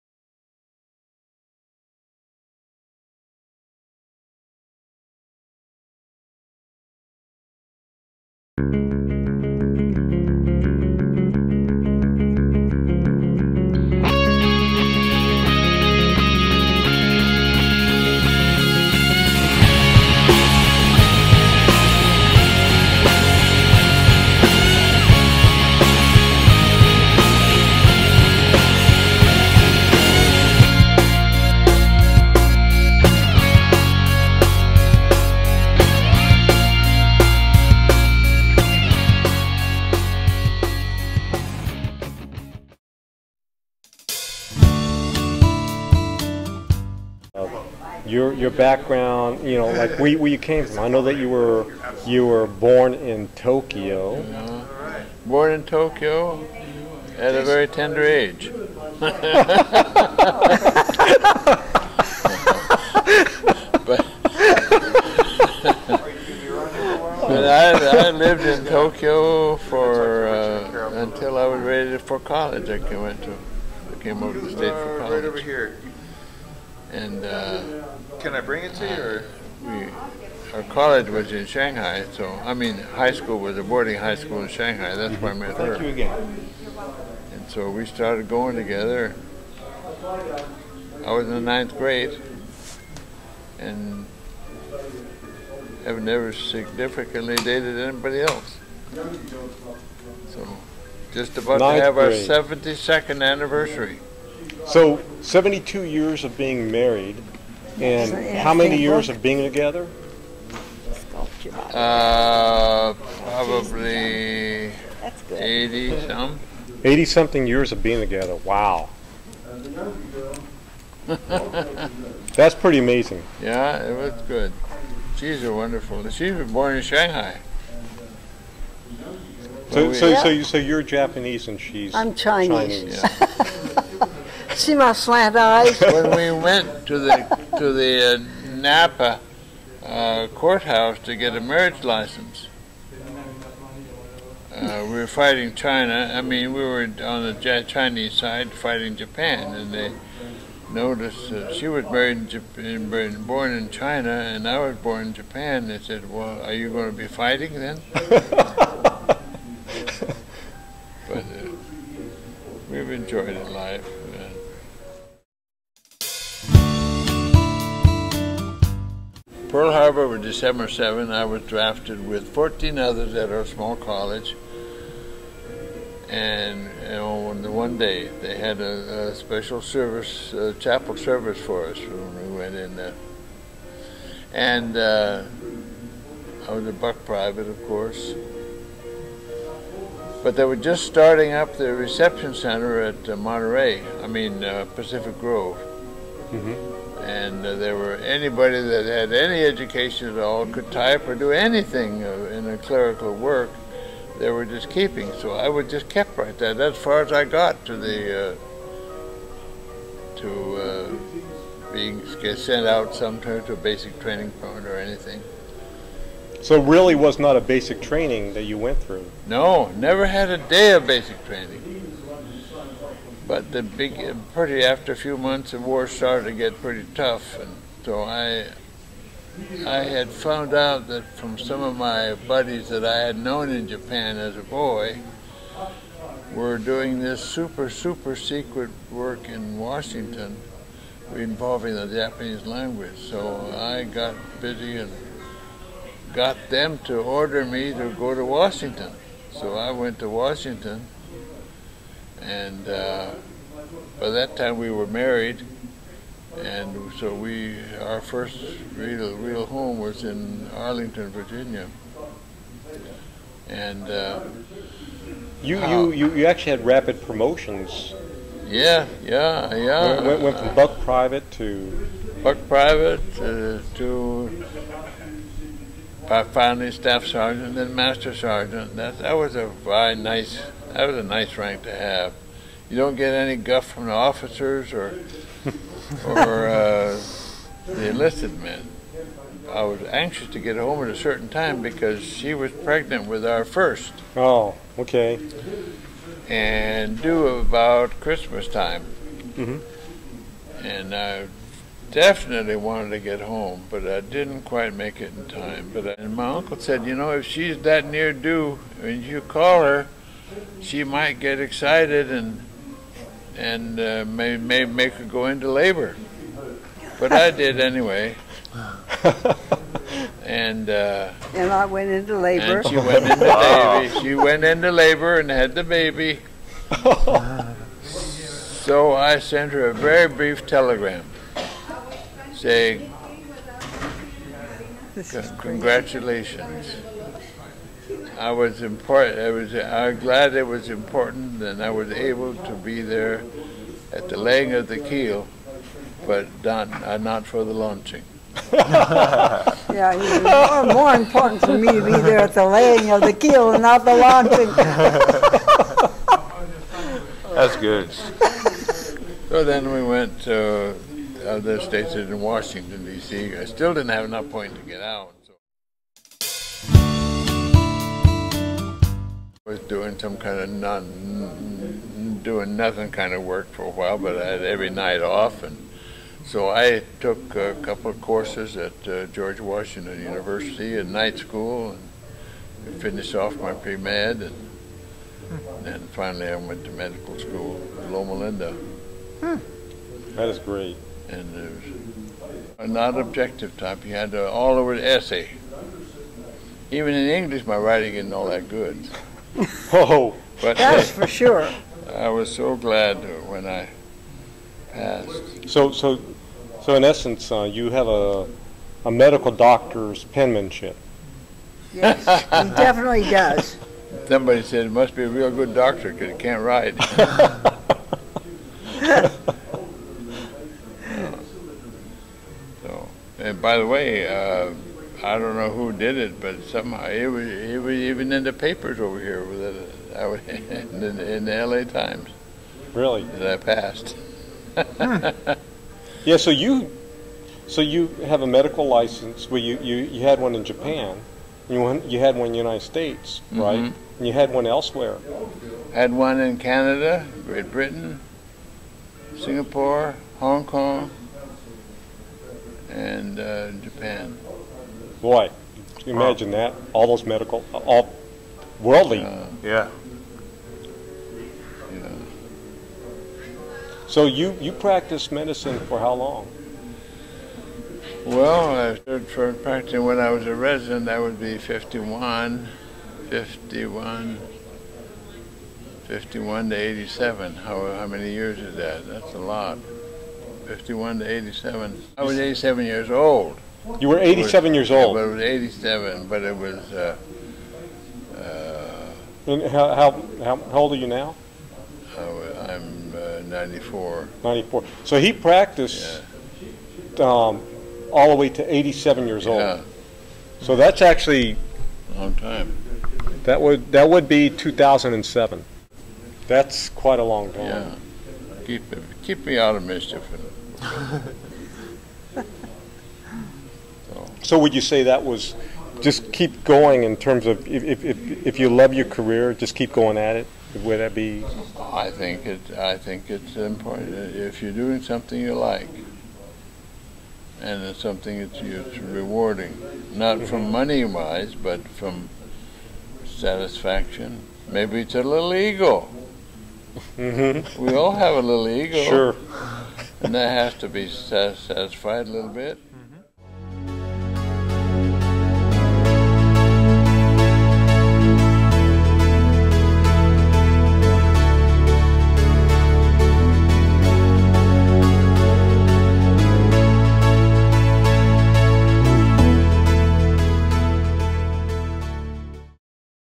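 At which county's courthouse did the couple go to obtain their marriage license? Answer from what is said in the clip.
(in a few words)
Napa.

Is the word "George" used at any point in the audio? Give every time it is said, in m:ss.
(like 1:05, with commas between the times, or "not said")
6:19.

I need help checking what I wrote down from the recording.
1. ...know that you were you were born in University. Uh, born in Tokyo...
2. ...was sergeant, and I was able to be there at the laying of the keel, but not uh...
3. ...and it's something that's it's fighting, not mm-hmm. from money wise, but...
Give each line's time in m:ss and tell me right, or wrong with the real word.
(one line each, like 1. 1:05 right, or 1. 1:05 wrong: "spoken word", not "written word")
1. 0:50 wrong: "Tokyo", not "University"
2. 5:40 wrong: "important", not "sergeant"
3. 8:47 wrong: "rewarding", not "fighting".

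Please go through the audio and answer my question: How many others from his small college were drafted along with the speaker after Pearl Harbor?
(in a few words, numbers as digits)
14.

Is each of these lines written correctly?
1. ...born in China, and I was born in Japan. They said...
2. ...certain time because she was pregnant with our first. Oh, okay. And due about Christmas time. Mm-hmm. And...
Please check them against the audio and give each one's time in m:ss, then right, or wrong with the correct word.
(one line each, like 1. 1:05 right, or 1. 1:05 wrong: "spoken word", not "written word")
1. 2:33 right
2. 4:50 right.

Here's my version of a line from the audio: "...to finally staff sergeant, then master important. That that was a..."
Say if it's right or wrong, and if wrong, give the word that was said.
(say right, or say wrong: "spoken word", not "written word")
wrong: "sergeant", not "important".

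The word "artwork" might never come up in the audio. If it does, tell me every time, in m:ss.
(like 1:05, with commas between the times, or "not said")
not said.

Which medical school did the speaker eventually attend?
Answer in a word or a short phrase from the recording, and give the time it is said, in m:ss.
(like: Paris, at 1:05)
Loma Linda, at 6:27.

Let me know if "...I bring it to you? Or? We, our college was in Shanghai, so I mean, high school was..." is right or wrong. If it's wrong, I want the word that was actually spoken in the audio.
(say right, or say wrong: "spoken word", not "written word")
right.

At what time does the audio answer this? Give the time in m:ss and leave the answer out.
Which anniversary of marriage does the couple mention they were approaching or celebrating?
1:42.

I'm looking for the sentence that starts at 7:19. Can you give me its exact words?
Well, you you, you had one in Japan.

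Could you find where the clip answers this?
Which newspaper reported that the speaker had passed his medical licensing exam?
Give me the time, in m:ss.
7:11.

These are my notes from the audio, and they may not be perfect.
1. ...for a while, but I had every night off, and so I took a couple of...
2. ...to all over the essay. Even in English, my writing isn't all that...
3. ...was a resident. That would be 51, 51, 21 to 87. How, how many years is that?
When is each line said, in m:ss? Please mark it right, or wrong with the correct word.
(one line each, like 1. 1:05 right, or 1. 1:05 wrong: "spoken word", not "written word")
1. 6:13 right
2. 6:34 right
3. 7:50 wrong: "51", not "21".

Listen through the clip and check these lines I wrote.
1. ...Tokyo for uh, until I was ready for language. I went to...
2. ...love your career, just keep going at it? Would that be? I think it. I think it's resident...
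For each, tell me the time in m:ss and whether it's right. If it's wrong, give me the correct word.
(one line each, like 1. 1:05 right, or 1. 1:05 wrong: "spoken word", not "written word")
1. 1:08 wrong: "college", not "language"
2. 8:38 wrong: "important", not "resident".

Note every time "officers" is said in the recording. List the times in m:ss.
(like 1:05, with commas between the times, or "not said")
4:43.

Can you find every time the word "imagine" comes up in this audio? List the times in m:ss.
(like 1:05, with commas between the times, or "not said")
7:35.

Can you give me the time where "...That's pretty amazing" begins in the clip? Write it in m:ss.
2:02.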